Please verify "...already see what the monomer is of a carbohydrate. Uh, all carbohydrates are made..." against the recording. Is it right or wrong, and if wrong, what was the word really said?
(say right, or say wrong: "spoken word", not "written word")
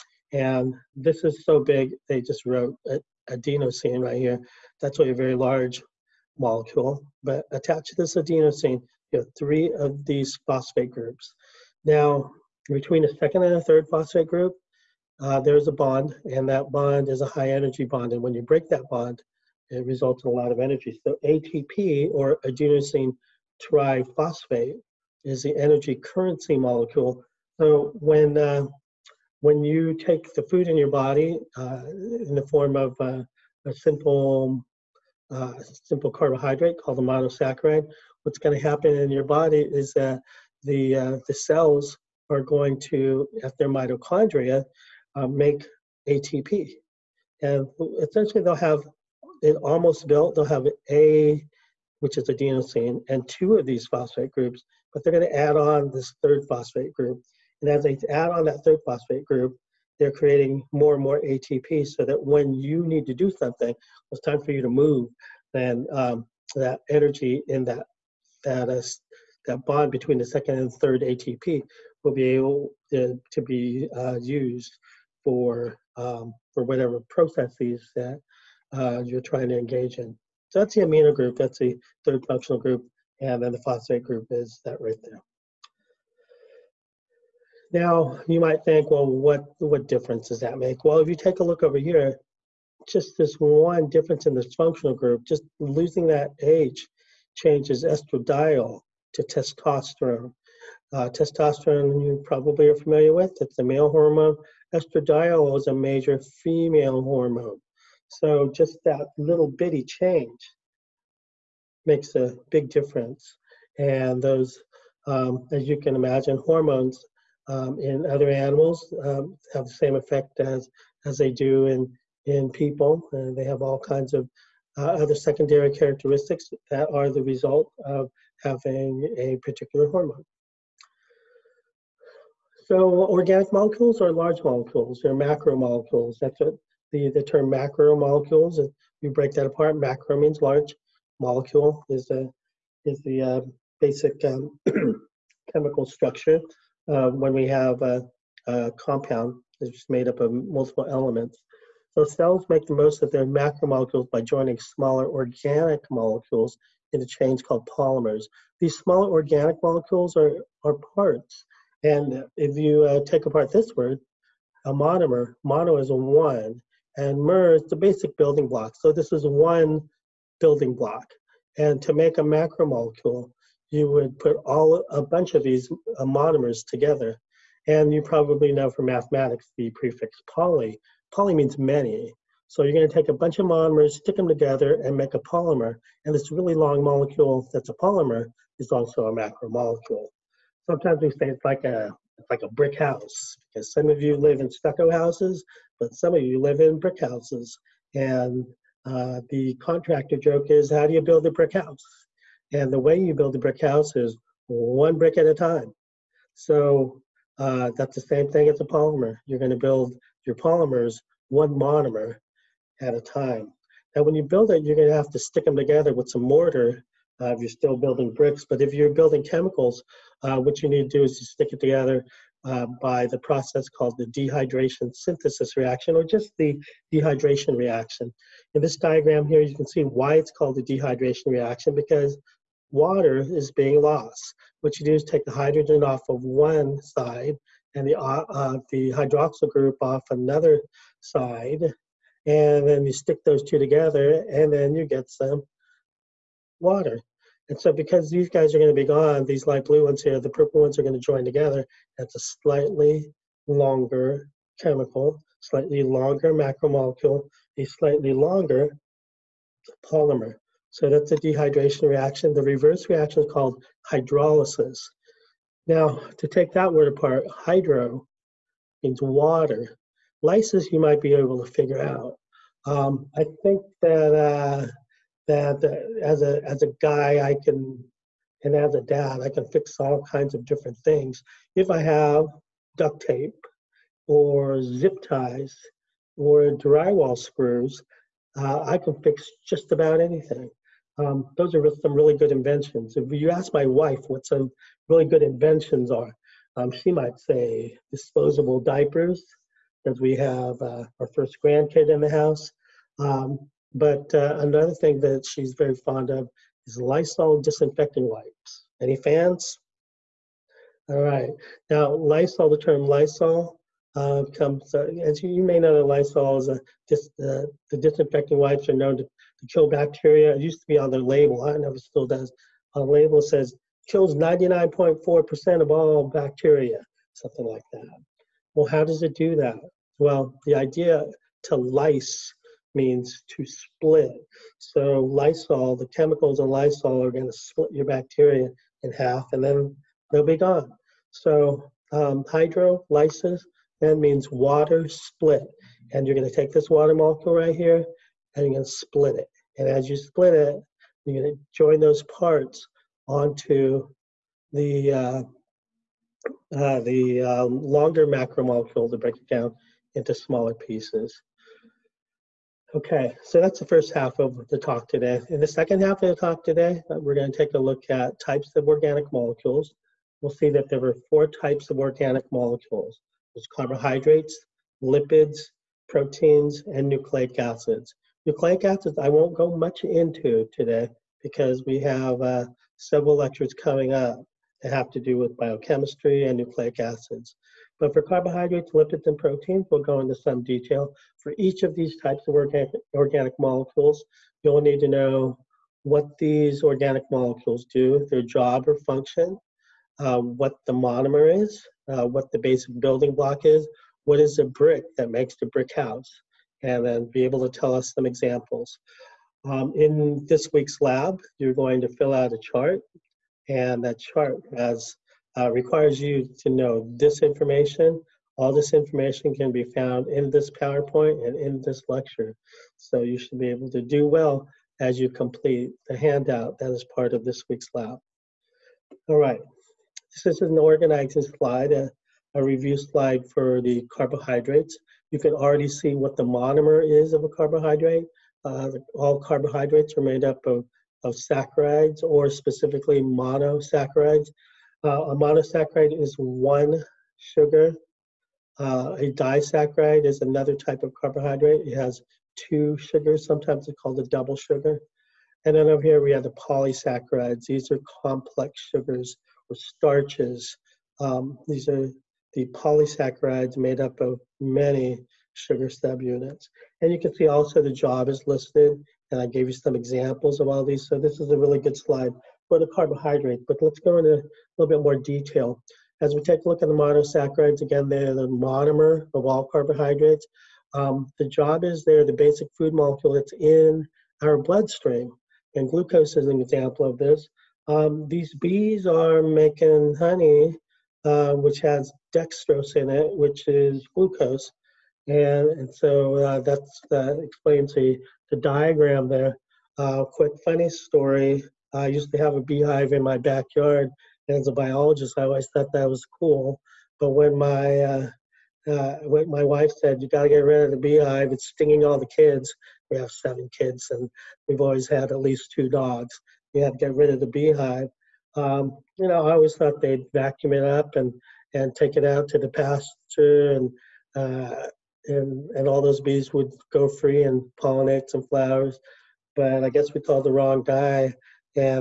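right.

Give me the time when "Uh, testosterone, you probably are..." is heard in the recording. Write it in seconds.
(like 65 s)
100 s.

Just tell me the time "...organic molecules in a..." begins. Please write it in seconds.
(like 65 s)
155 s.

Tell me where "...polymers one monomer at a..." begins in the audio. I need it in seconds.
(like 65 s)
210 s.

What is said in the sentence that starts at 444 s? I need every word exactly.
Uh, a monosaccharide is one sugar.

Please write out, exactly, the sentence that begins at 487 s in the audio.
Um, these bees are making honey, uh, which has dextrose in it, which is glucose.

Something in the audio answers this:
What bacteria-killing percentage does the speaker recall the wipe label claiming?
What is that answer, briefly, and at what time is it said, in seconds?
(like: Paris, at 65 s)
99.4%, at 324 s.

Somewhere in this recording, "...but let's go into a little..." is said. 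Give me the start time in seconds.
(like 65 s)
473 s.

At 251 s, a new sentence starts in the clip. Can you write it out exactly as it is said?
That's a slightly longer chemical, slightly longer macromolecule, a slightly longer polymer.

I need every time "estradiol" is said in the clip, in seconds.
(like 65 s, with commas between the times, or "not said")
97 s, 104 s.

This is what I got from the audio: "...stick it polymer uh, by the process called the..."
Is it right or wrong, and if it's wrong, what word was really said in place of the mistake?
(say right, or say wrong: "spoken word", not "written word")
wrong: "together", not "polymer".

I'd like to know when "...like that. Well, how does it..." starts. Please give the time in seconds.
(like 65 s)
327 s.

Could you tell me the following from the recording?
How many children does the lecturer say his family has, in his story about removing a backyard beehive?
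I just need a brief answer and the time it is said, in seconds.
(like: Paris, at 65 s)
7, at 513 s.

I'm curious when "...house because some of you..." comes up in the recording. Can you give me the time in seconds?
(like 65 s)
192 s.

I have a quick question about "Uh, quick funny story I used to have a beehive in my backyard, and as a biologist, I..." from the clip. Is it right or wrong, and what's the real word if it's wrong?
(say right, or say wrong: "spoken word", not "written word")
right.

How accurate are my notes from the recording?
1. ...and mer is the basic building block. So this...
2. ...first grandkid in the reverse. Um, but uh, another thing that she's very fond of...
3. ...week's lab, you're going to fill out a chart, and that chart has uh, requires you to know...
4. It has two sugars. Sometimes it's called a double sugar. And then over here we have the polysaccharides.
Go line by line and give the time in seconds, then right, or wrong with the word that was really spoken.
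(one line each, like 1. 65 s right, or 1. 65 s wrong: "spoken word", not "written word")
1. 166 s right
2. 301 s wrong: "house", not "reverse"
3. 410 s right
4. 451 s right.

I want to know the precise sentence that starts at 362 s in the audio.
Okay, so that's the first half of the talk today.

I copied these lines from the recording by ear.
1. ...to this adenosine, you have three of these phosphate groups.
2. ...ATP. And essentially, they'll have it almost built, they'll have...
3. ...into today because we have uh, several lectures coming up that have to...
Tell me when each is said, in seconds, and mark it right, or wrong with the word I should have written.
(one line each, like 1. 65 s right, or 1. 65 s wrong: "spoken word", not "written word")
1. 7 s right
2. 46 s right
3. 379 s right.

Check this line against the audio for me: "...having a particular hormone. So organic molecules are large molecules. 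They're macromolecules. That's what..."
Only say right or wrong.
right.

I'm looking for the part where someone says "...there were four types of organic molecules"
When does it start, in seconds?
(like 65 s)
370 s.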